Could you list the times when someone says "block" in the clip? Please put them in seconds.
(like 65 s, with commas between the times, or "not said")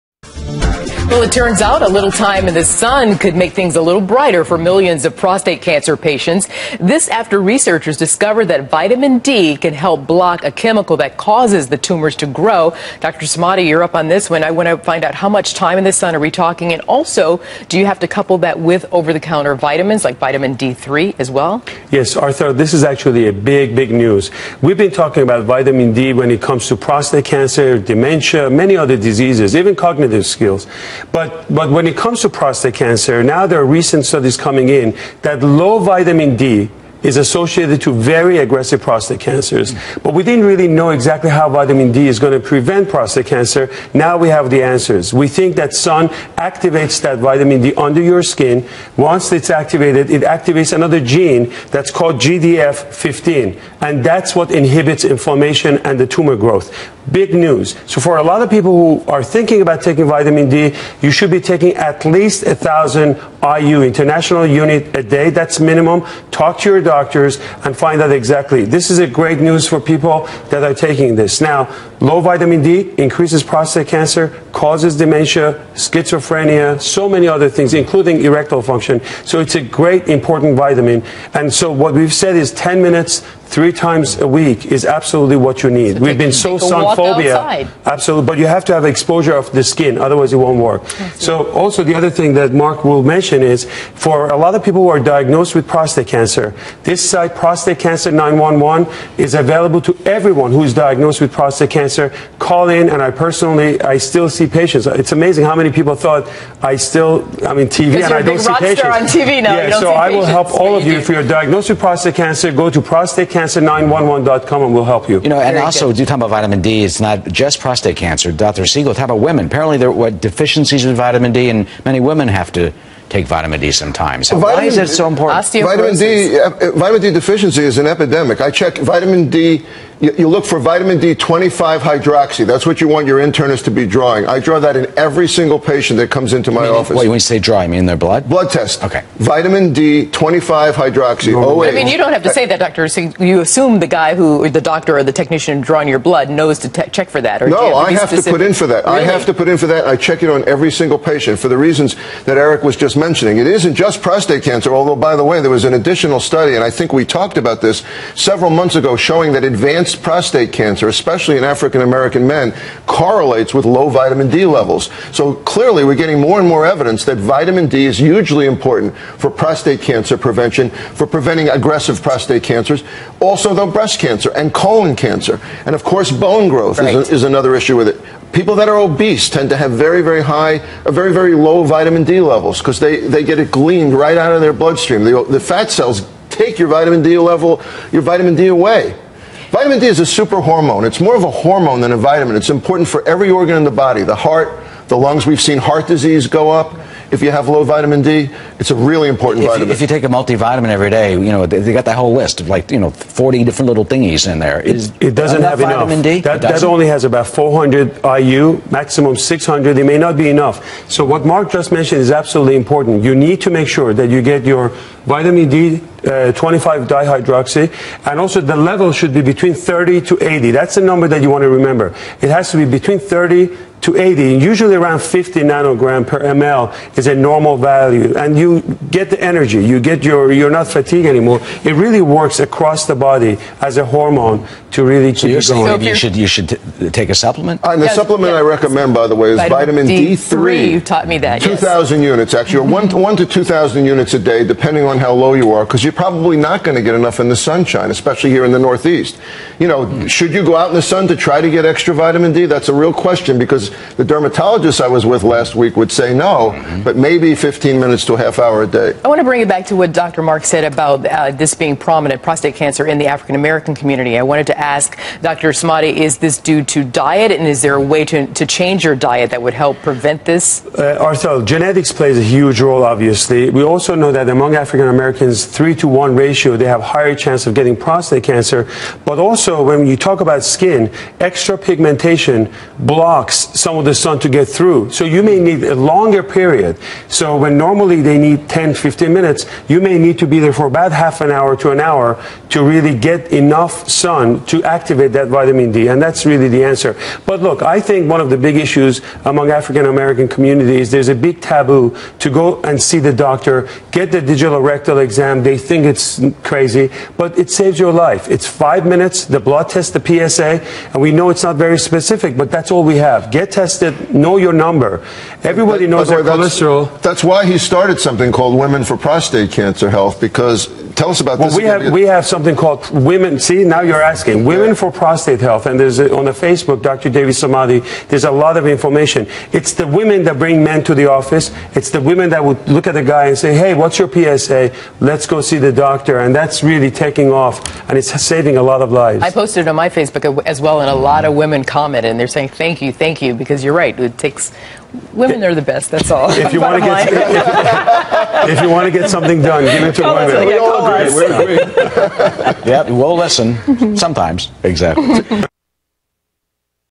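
10 s, 282 s.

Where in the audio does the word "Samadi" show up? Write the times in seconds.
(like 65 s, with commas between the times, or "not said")
13 s, 265 s, 327 s.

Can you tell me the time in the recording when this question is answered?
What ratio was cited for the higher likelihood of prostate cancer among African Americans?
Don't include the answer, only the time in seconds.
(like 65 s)
275 s.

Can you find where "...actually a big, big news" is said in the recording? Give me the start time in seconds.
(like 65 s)
22 s.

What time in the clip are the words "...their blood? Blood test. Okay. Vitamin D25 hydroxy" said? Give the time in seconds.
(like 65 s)
137 s.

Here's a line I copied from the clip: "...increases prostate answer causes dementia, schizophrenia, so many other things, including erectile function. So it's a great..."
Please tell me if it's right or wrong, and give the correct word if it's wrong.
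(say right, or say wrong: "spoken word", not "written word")
wrong: "cancer", not "answer".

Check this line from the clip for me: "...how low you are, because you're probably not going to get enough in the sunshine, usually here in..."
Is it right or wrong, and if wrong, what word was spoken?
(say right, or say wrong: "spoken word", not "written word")
wrong: "especially", not "usually".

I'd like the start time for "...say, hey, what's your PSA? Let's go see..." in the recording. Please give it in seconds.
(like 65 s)
333 s.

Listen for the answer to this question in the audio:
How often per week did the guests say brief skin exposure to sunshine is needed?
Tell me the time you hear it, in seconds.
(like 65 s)
83 s.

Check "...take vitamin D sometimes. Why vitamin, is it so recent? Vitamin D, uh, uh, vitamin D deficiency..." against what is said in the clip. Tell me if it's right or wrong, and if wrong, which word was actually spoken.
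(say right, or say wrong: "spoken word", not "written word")
wrong: "important", not "recent".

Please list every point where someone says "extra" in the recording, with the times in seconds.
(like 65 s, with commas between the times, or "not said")
251 s, 281 s.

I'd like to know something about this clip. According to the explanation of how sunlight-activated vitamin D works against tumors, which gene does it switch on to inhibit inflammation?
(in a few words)
GDF15.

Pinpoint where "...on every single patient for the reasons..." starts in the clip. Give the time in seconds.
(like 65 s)
150 s.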